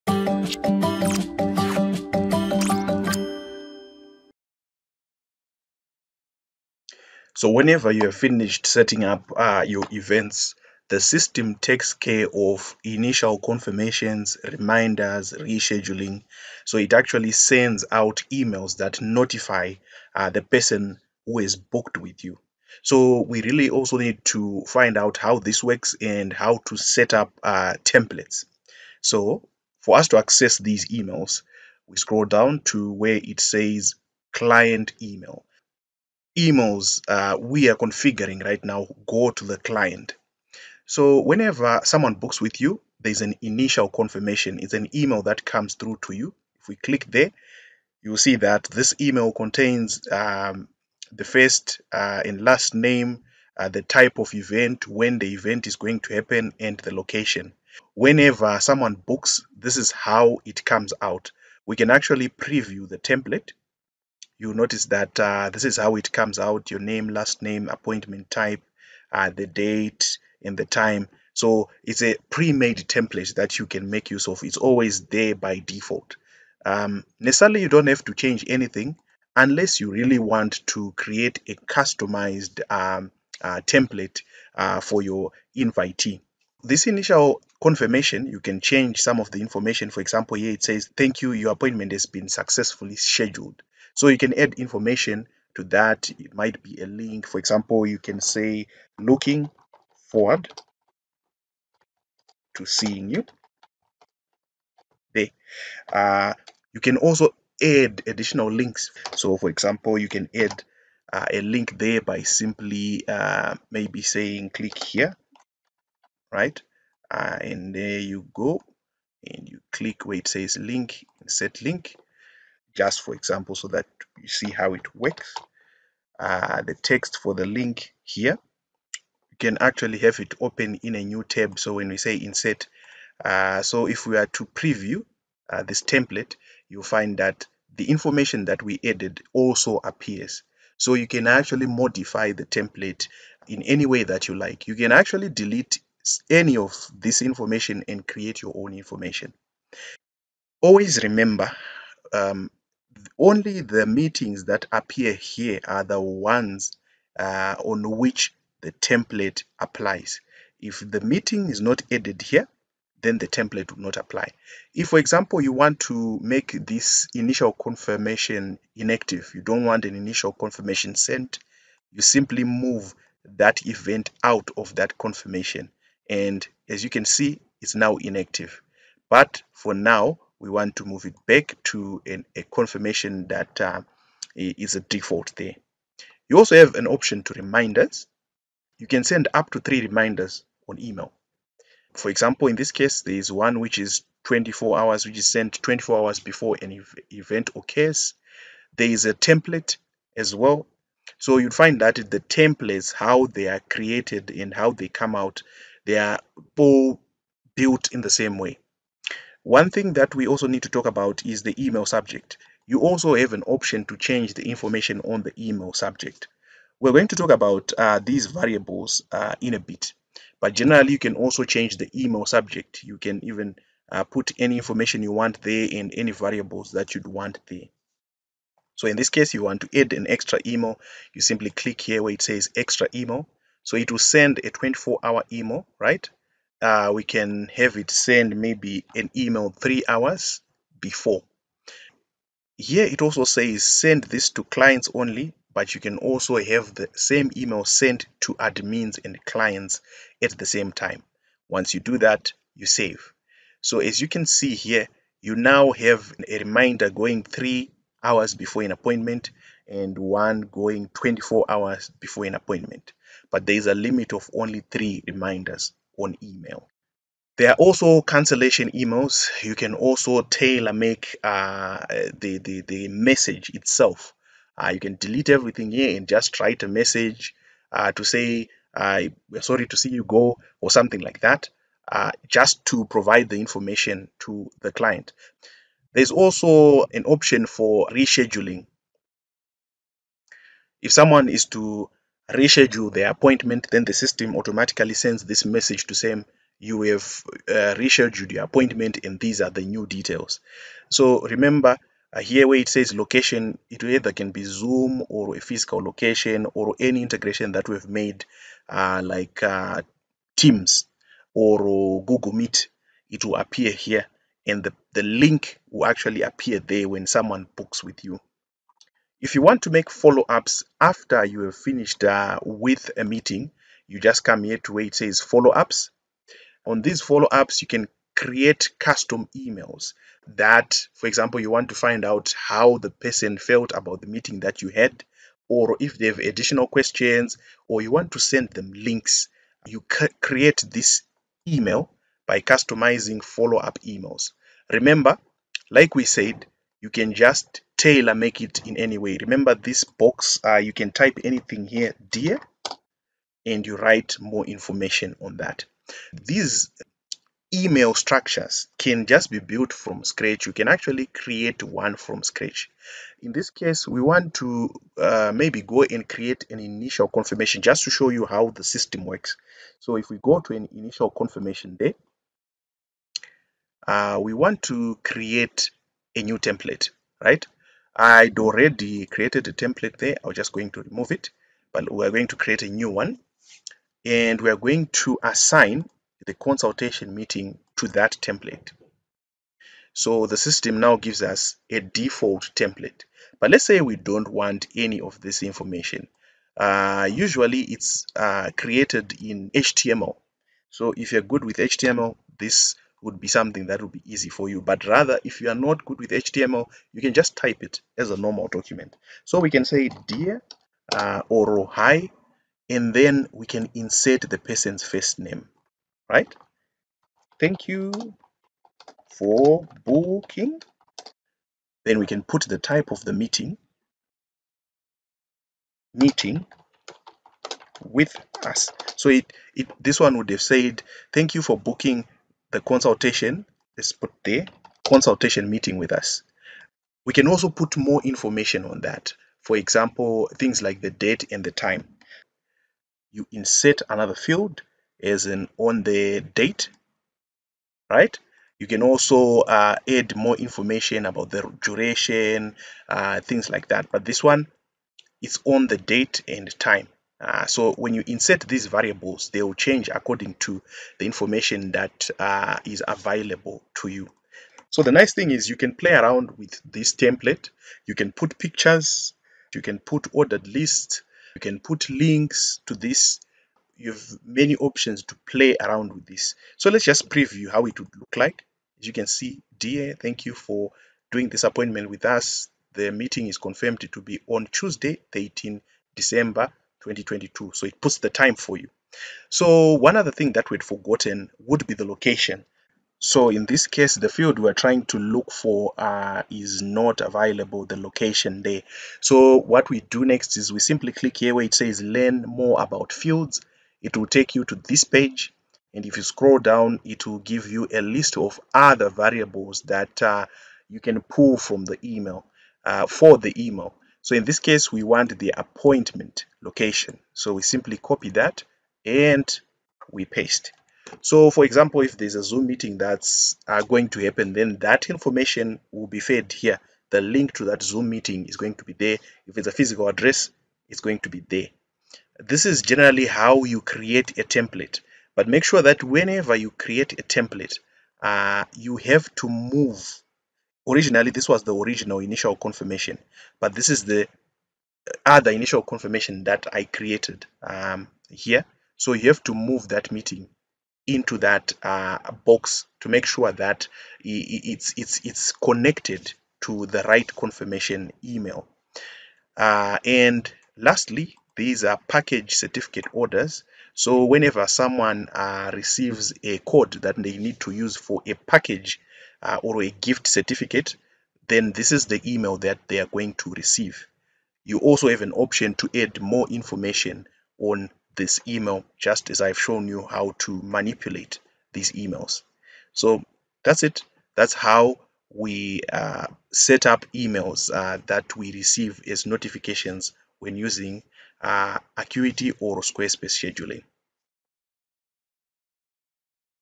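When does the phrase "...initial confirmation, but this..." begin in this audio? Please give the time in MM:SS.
09:01.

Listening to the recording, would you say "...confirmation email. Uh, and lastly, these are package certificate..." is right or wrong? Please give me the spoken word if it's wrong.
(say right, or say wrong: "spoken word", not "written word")
right.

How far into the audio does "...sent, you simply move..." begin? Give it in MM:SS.
02:50.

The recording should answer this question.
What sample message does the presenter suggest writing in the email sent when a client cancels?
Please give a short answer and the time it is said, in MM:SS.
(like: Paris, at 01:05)
We're sorry to see you go, at 04:38.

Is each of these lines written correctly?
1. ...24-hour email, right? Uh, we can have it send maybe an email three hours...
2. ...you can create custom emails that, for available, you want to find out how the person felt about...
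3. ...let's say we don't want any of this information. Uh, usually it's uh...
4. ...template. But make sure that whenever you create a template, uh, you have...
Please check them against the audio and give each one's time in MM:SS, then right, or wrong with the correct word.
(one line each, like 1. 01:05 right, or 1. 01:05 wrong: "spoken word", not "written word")
1. 03:54 right
2. 05:27 wrong: "example", not "available"
3. 06:33 right
4. 08:54 right.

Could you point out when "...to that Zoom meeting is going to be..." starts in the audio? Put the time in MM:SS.
08:47.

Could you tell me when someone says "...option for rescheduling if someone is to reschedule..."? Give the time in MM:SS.
04:47.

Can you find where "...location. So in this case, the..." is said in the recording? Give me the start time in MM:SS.
08:11.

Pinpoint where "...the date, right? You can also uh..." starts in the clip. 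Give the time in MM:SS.
07:25.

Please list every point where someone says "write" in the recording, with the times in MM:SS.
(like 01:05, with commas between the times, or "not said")
04:36, 05:53.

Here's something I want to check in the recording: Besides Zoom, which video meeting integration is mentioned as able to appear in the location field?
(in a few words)
Teams.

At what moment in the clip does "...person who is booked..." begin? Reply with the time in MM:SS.
00:20.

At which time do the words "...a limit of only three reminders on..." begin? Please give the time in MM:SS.
04:23.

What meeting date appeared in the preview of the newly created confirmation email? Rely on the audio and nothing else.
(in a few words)
Tuesday, 18 December 2022.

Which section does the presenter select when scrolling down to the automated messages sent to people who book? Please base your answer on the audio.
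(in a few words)
Client email.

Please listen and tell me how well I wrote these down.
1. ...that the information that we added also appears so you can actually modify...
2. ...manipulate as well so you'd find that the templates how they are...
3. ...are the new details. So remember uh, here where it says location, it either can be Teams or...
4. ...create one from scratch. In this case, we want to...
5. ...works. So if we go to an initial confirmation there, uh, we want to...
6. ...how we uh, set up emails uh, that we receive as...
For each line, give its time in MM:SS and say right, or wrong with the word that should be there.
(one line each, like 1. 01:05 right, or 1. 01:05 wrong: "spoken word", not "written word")
1. 02:17 right
2. 03:19 wrong: "template", not "manipulate"
3. 04:59 wrong: "Zoom", not "Teams"
4. 06:01 right
5. 06:09 right
6. 09:44 right.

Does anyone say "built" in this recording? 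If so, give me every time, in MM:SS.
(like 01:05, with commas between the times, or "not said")
03:27, 05:59.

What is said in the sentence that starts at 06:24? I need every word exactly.
And we're going to assign the consultation meeting to that template.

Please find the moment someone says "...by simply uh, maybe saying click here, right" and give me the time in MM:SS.
01:52.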